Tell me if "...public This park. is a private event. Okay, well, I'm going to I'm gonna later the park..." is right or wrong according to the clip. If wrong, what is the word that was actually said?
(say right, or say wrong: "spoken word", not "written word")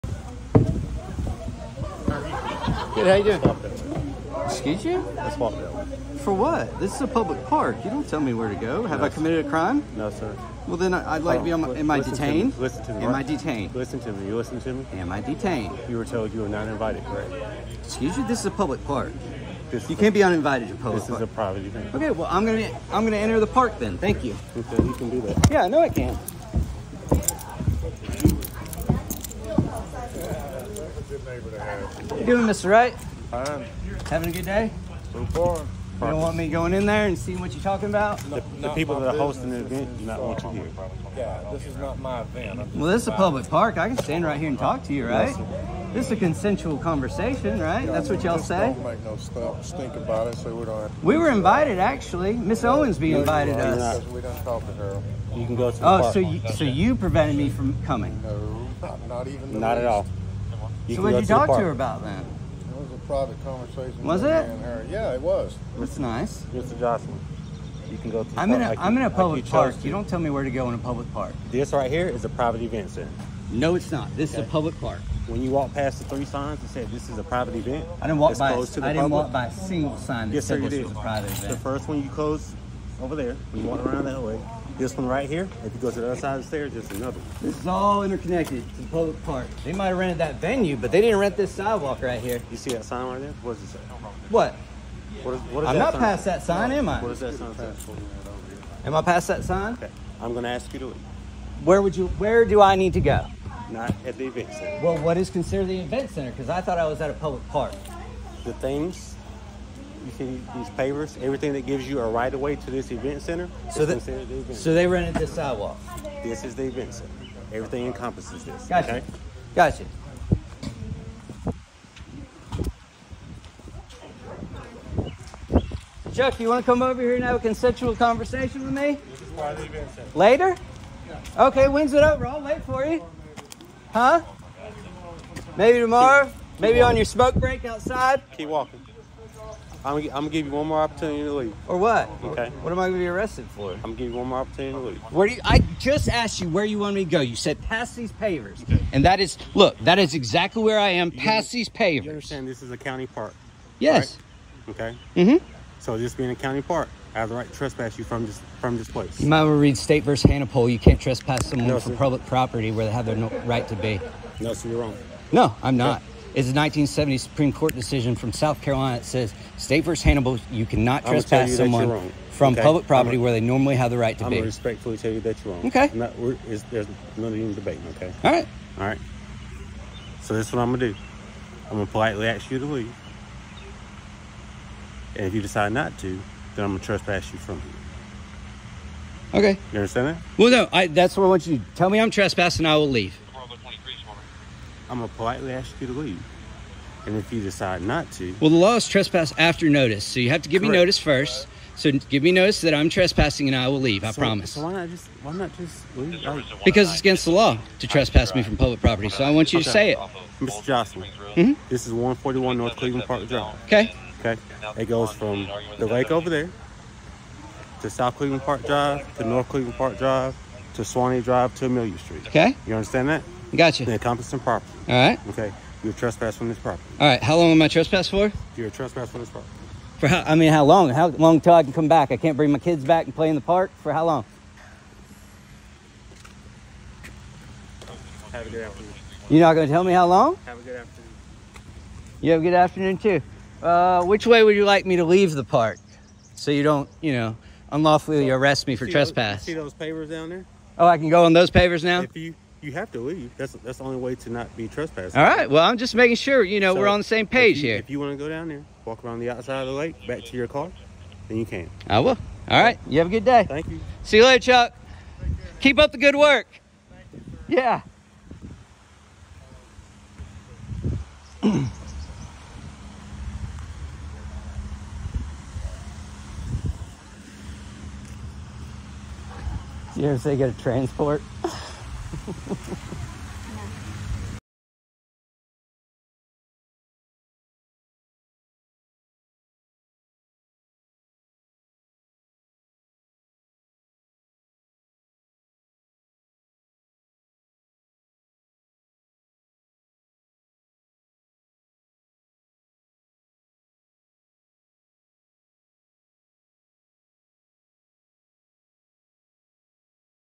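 wrong: "enter", not "later".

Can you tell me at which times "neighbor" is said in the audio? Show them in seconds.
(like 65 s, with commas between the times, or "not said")
31 s.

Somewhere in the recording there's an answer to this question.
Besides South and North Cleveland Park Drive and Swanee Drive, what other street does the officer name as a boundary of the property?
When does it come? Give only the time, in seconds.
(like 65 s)
221 s.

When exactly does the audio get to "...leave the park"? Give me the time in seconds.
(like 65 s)
245 s.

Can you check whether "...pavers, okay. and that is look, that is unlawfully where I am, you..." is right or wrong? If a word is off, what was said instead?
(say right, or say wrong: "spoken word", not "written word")
wrong: "exactly", not "unlawfully".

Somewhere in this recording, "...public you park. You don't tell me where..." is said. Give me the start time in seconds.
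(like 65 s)
69 s.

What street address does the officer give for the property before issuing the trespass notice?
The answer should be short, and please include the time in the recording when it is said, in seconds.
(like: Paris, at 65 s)
141 North Cleveland Park Drive, at 211 s.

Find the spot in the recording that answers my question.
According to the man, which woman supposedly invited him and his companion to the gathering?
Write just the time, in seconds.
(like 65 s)
52 s.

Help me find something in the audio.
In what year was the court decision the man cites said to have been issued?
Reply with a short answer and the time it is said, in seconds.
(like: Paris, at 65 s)
1970, at 166 s.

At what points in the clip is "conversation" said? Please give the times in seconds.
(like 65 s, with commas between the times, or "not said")
46 s, 63 s, 127 s.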